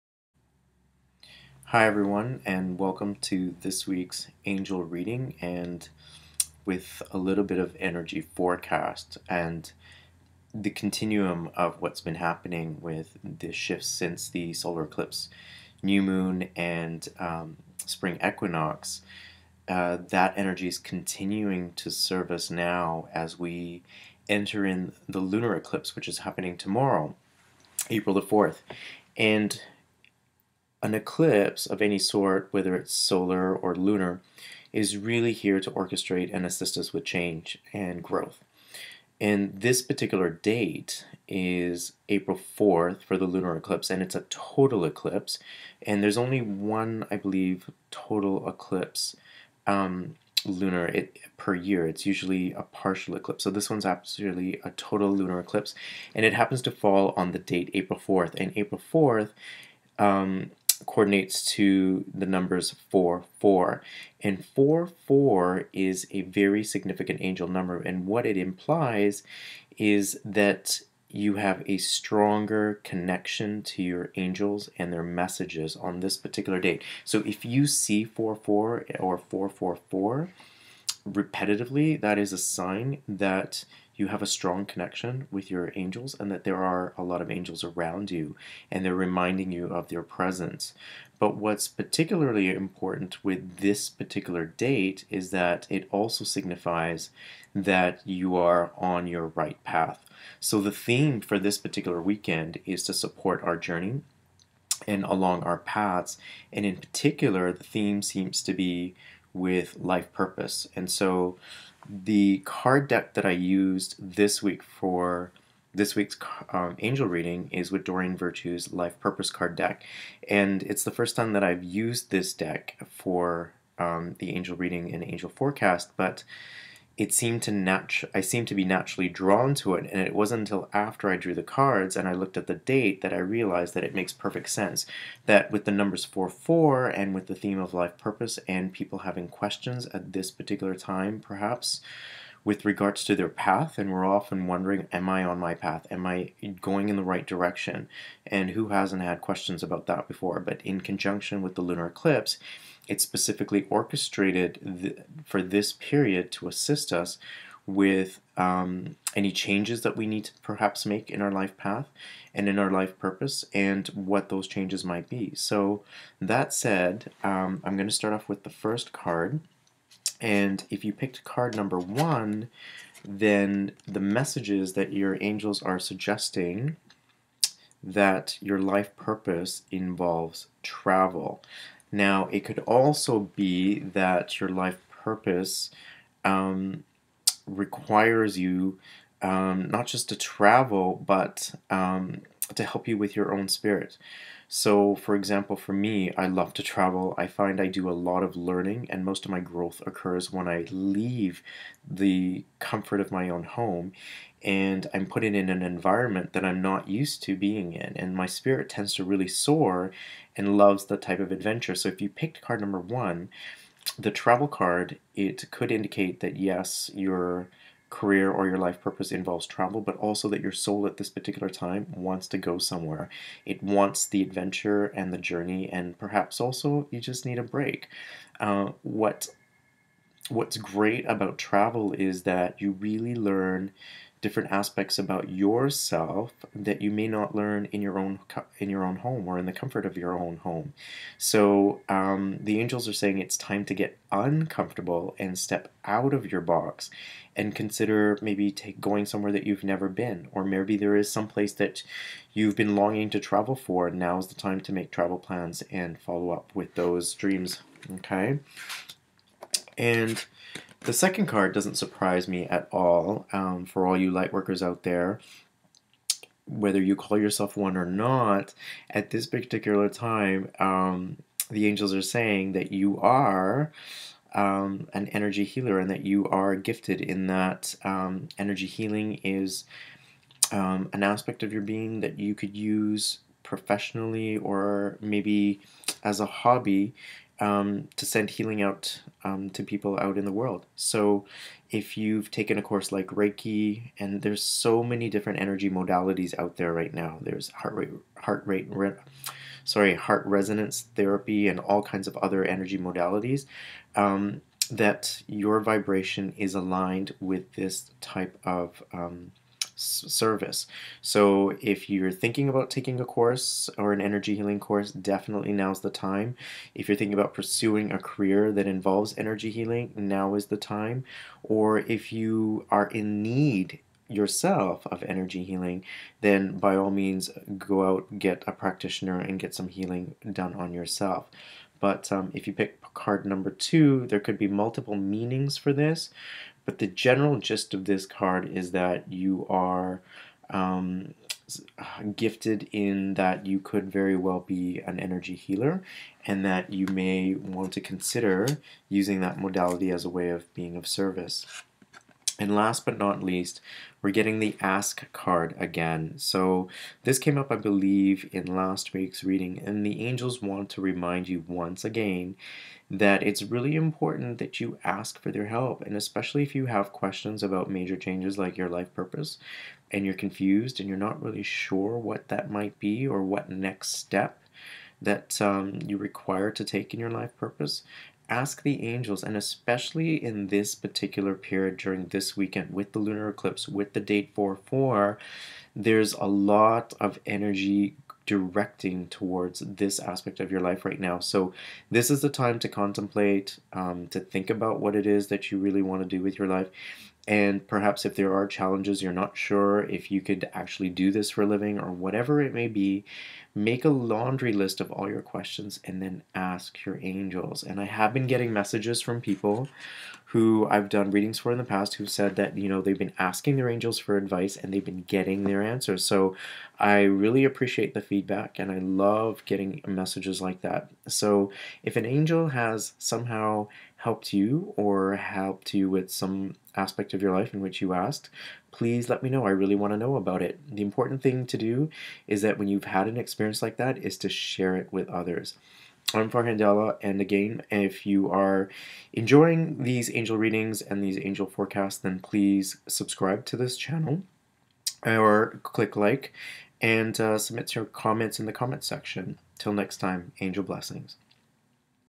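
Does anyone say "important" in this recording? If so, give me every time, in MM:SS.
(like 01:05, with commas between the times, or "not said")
01:32, 06:03, 07:10.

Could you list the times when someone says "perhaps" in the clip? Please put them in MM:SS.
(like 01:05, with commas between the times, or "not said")
02:21, 02:40, 03:45, 06:37.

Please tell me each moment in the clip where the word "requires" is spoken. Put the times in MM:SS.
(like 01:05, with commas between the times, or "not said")
03:07, 06:15.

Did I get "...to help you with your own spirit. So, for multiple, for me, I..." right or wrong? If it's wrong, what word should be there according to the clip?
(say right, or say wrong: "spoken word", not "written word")
wrong: "example", not "multiple".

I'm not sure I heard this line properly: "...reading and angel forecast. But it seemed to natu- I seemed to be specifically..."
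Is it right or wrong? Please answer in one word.
wrong.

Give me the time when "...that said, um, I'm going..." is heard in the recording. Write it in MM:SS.
02:46.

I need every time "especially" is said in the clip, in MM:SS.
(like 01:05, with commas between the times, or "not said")
06:05, 06:19.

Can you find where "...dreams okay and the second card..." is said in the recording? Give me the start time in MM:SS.
04:17.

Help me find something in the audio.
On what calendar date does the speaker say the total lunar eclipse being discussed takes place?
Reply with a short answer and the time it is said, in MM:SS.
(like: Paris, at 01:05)
April 4th, at 00:42.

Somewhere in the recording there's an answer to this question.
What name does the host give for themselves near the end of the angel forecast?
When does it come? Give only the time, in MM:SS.
07:16.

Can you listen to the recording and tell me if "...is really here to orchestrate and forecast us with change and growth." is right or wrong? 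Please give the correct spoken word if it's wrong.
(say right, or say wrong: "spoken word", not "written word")
wrong: "assist", not "forecast".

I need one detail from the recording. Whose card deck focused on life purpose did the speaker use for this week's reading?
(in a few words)
Doreen Virtue.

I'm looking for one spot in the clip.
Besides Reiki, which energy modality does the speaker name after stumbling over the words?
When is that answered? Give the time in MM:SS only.
04:59.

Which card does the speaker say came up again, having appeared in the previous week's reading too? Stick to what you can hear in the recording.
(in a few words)
The ask card.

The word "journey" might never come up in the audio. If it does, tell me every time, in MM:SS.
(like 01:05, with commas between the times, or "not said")
01:43, 03:45.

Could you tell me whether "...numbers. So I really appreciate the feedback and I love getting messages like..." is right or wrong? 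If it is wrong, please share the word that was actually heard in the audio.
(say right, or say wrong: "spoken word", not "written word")
wrong: "answers", not "numbers".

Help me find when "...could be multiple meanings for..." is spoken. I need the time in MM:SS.
05:34.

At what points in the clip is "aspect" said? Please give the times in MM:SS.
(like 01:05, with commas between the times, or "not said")
03:54, 04:41, 06:29, 07:06.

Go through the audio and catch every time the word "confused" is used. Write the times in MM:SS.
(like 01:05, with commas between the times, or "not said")
06:10.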